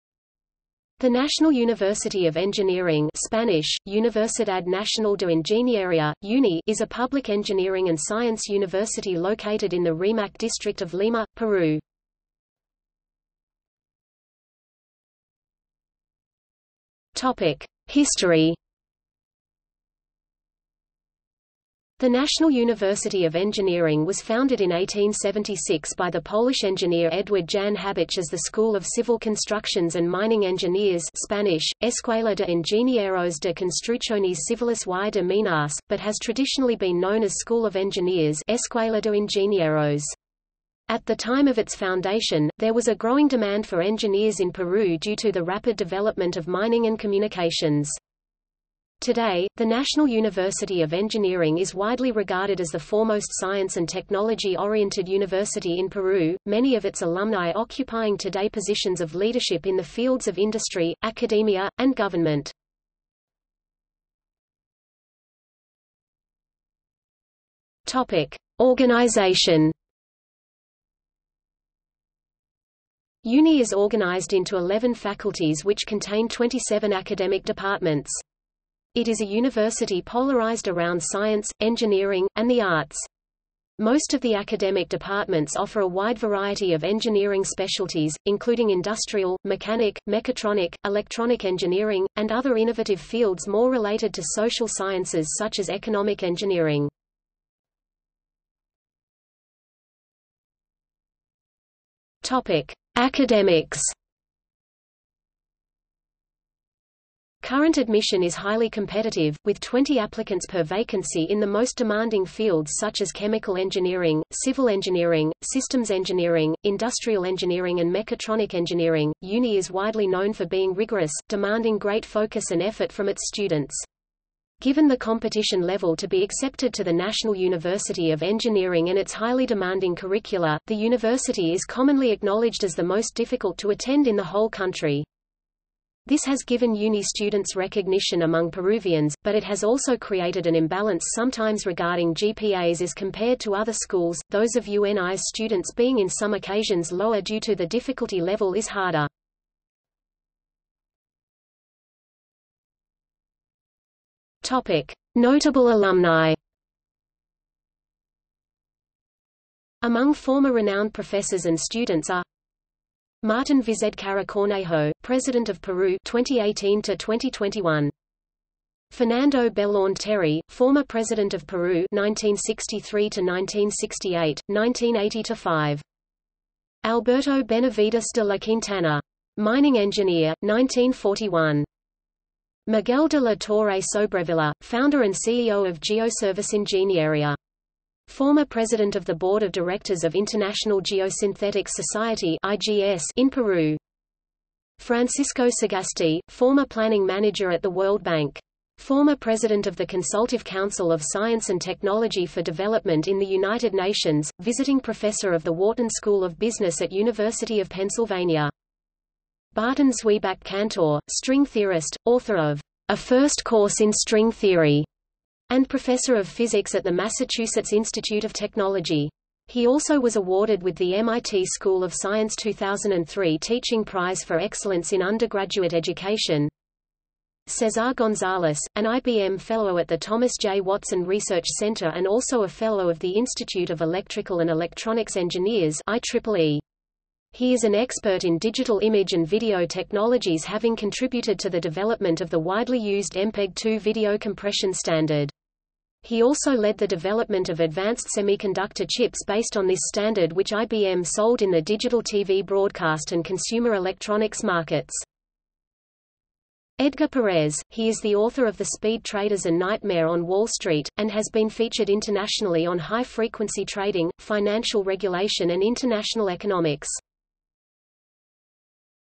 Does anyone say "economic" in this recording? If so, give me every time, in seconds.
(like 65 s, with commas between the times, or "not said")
95 s, 266 s.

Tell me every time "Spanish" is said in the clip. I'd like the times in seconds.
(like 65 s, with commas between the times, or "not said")
3 s, 31 s.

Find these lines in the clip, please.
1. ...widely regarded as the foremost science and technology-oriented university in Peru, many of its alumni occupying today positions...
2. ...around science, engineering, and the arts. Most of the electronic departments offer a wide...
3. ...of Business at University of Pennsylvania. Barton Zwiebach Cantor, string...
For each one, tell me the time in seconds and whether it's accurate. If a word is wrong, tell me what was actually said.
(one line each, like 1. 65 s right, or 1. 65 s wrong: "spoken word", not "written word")
1. 51 s right
2. 80 s wrong: "academic", not "electronic"
3. 206 s right.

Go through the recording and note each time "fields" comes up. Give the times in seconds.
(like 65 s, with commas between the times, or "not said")
59 s, 92 s, 112 s.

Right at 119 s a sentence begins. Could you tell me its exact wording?
UNI is widely known for being rigorous, demanding great focus and effort from its students.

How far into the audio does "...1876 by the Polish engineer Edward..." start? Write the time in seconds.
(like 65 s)
24 s.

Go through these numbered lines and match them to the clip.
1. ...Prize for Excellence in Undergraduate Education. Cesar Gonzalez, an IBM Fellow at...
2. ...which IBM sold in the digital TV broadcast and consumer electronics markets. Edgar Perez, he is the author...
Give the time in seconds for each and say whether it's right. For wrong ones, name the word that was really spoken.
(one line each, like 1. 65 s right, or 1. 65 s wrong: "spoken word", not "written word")
1. 223 s right
2. 250 s right.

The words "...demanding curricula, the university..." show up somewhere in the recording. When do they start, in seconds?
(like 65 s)
129 s.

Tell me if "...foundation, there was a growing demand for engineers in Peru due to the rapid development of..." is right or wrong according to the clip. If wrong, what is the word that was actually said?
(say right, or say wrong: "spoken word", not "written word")
right.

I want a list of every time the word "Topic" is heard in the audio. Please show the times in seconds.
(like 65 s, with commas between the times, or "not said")
67 s, 102 s.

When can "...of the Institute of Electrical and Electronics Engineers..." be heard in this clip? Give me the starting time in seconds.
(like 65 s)
232 s.